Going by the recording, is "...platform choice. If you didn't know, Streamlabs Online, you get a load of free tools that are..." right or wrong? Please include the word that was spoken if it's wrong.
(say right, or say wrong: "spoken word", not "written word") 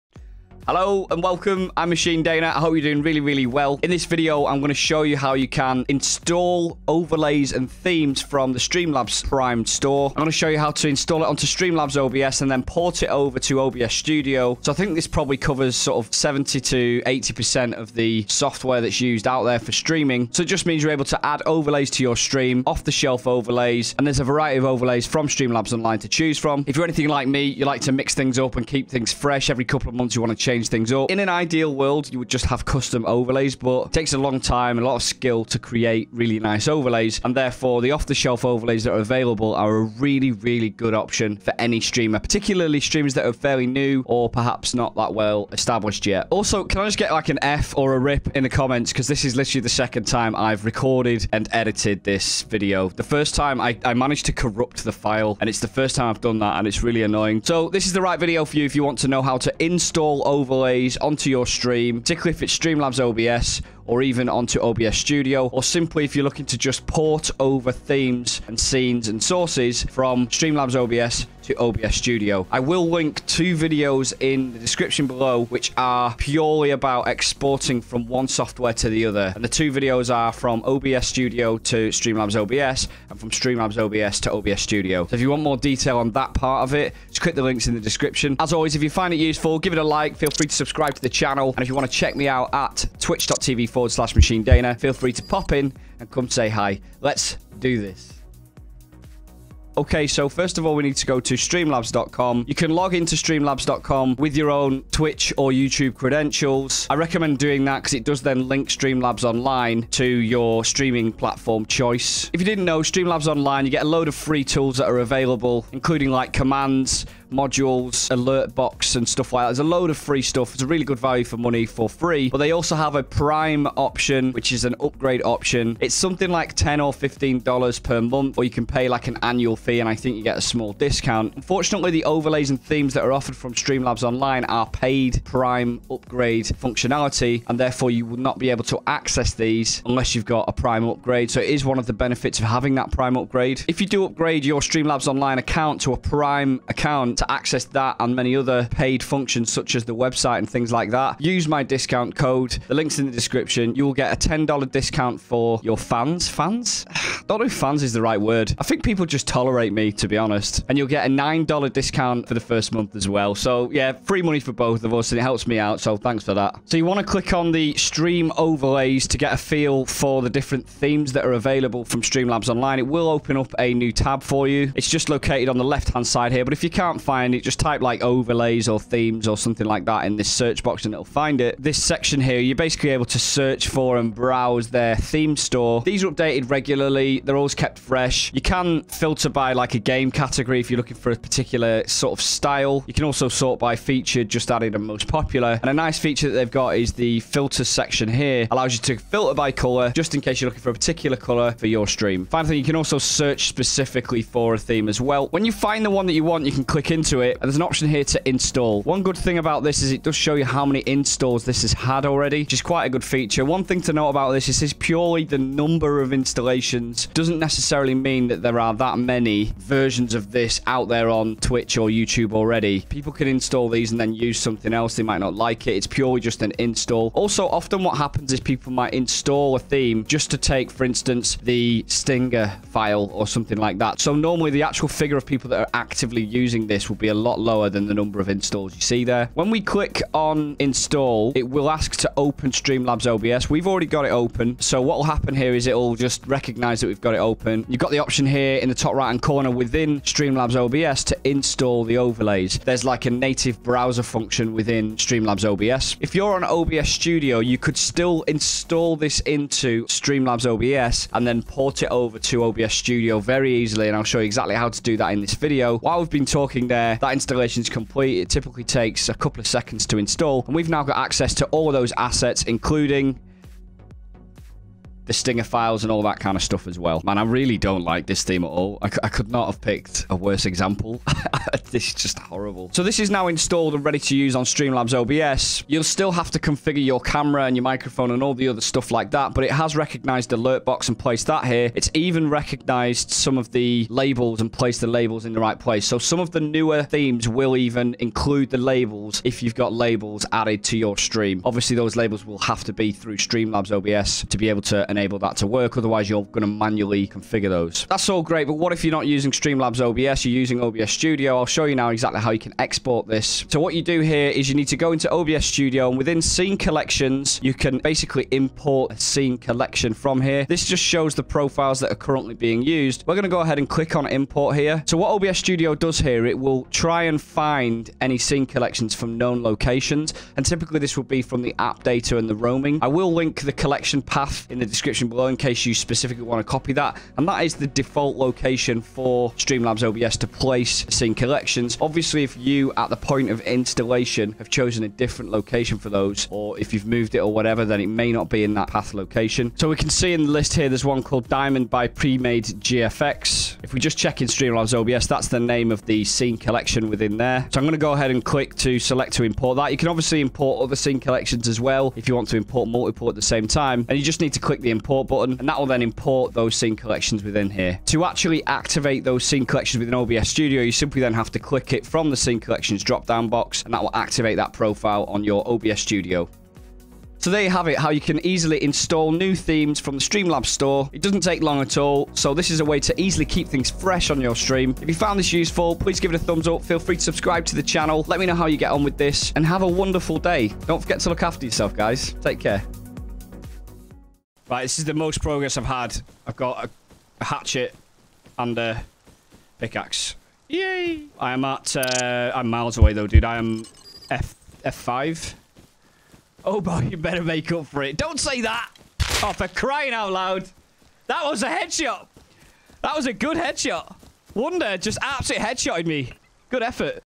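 right.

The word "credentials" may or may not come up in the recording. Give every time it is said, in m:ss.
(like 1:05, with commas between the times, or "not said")
1:45.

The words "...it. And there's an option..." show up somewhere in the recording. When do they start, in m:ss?
3:27.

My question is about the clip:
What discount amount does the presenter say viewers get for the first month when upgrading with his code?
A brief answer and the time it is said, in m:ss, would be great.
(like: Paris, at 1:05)
$9, at 2:41.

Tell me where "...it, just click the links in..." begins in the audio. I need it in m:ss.
1:26.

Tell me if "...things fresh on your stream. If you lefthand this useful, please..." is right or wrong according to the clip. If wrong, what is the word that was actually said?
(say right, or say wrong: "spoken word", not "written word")
wrong: "found", not "lefthand".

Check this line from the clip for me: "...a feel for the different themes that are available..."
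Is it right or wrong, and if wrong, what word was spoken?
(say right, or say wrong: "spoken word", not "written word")
right.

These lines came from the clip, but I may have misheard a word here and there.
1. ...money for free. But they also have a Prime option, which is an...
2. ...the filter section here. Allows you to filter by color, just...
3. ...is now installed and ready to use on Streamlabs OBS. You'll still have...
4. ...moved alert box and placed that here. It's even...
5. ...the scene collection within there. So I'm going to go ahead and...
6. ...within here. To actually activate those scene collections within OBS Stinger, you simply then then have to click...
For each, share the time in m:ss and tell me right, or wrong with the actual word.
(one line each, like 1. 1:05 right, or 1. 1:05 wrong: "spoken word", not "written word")
1. 2:01 right
2. 3:16 right
3. 4:42 right
4. 4:49 wrong: "recognized", not "moved"
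5. 5:55 right
6. 6:07 wrong: "Studio", not "Stinger".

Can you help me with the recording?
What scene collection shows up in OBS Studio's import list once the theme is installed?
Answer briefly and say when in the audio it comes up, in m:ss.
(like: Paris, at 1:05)
Diamond by Pre-Made GFX, at 5:51.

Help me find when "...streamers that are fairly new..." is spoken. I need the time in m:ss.
0:42.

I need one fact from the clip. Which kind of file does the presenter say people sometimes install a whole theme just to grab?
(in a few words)
Stinger file.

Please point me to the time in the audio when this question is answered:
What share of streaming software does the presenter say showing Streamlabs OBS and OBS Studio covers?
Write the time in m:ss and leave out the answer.
0:16.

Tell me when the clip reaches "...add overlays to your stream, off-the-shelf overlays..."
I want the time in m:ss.
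0:21.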